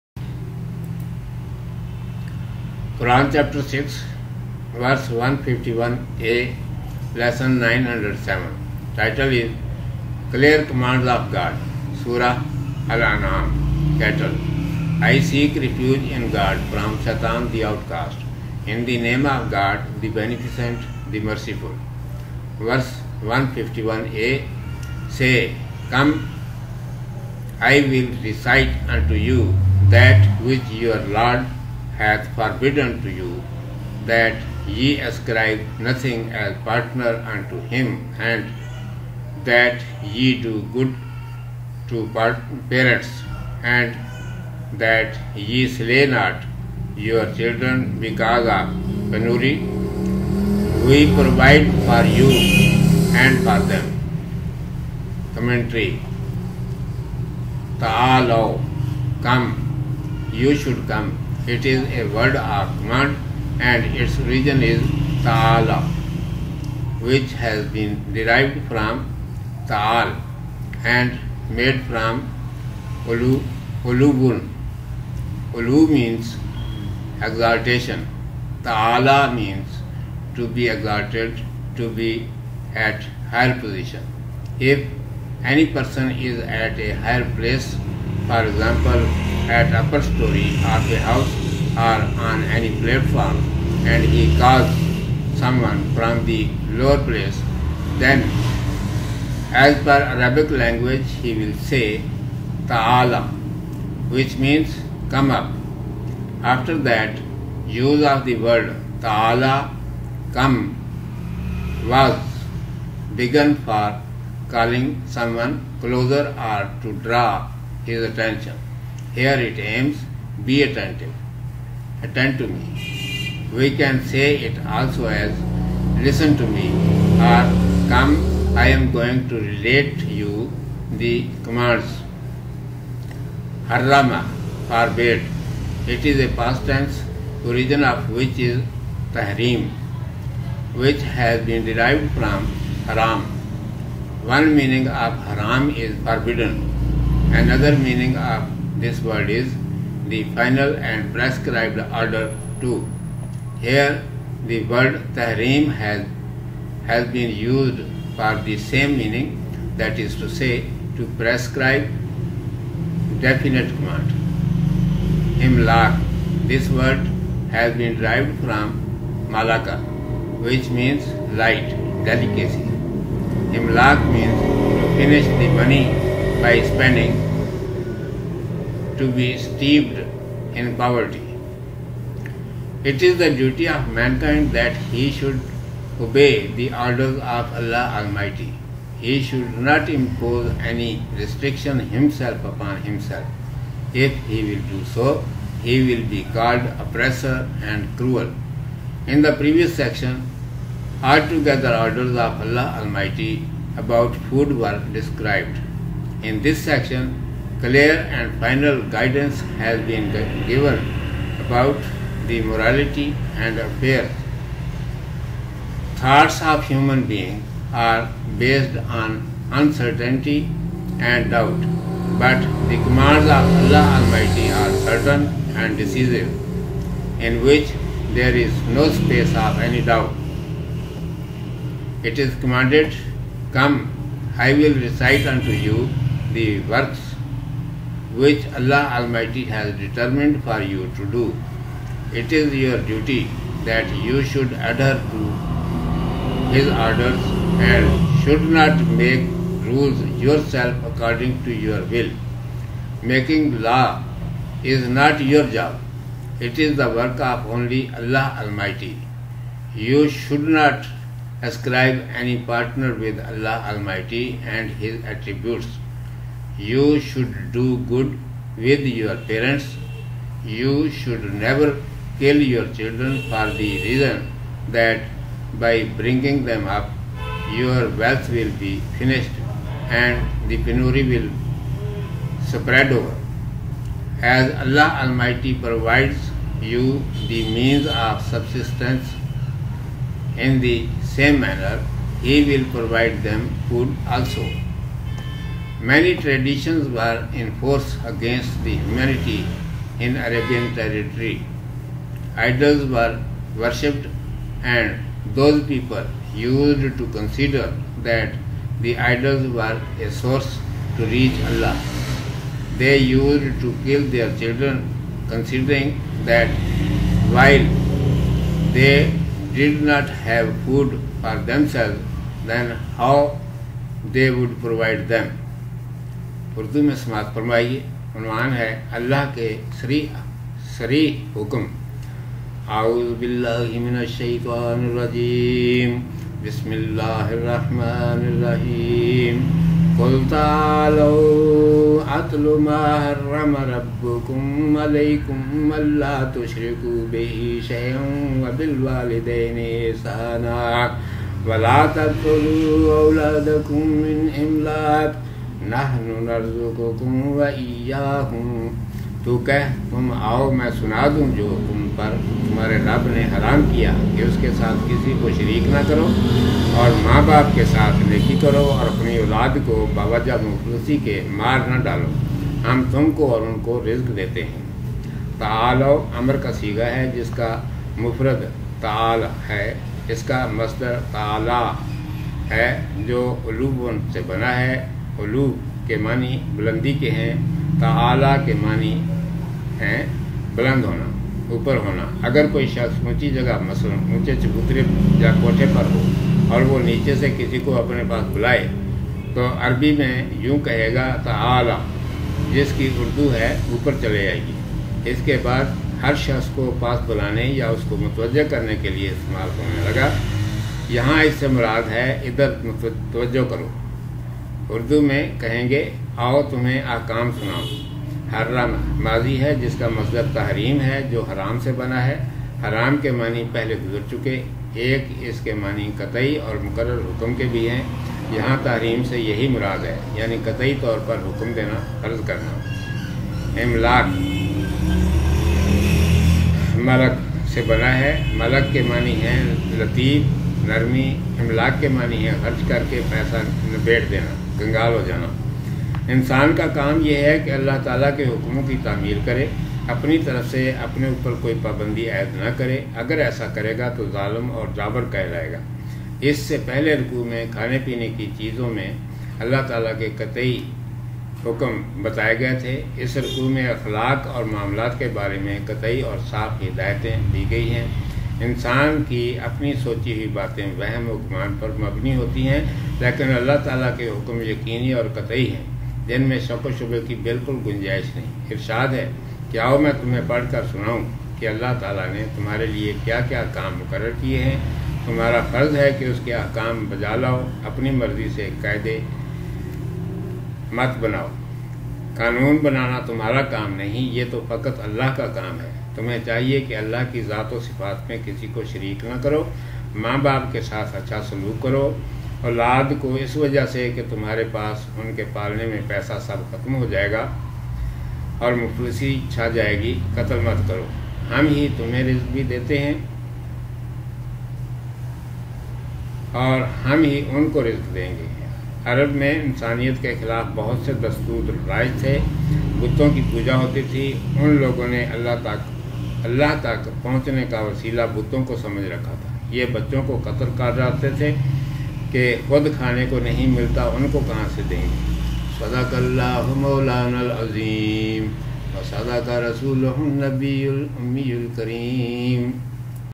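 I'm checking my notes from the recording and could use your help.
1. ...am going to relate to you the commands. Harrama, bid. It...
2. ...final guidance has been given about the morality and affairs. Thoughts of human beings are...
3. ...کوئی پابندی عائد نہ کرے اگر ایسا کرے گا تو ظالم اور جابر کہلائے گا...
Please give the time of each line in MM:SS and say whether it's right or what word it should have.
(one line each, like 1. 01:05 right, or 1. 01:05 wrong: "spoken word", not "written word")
1. 02:08 right
2. 03:28 right
3. 07:31 right.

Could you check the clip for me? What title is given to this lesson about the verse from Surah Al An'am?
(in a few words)
Clear Commands of God.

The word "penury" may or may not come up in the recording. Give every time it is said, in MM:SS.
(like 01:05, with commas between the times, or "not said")
00:49, 04:40.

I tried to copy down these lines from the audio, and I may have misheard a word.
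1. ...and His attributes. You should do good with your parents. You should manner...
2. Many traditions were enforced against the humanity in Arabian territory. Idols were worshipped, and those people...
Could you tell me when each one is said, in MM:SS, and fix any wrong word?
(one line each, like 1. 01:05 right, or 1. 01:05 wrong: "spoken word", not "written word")
1. 04:24 wrong: "never", not "manner"
2. 04:55 right.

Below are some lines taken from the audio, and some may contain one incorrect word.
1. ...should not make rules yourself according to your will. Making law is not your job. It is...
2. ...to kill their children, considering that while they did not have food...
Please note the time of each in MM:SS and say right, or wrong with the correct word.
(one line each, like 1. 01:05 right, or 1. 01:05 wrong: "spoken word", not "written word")
1. 04:08 right
2. 05:13 right.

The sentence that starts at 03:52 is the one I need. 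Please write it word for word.
It is commanded, Come, I will recite unto you the works which Allah Almighty has determined for you to do.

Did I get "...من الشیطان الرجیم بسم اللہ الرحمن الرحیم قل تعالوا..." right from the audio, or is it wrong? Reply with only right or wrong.
right.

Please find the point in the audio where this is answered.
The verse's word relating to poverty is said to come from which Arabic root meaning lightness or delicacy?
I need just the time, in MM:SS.
02:49.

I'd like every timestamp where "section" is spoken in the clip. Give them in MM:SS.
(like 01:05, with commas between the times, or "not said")
03:19, 03:26.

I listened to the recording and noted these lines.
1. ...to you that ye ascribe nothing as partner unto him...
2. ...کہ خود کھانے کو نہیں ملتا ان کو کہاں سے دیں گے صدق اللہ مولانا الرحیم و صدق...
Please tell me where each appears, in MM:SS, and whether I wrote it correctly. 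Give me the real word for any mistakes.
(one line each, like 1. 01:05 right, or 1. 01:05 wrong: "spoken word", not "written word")
1. 00:33 right
2. 08:52 wrong: "العظیم", not "الرحیم".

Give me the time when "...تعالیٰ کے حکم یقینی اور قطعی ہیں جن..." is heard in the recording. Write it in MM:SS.
07:53.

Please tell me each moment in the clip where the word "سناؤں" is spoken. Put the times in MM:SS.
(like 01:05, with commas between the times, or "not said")
06:57, 08:00.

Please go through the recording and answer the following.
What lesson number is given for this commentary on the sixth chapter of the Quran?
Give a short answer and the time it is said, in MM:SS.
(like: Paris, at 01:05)
907, at 00:07.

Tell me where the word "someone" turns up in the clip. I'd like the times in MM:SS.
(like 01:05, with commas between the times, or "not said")
01:35, 01:55.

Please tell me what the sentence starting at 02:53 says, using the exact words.
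Himlak means to finish the money by spending to be steeped in poverty.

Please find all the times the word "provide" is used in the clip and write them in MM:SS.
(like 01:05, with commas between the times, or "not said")
00:51, 04:45, 04:52, 05:24.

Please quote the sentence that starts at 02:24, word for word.
One meaning of haram is forbidden, another meaning of this word is the final and prescribed order too.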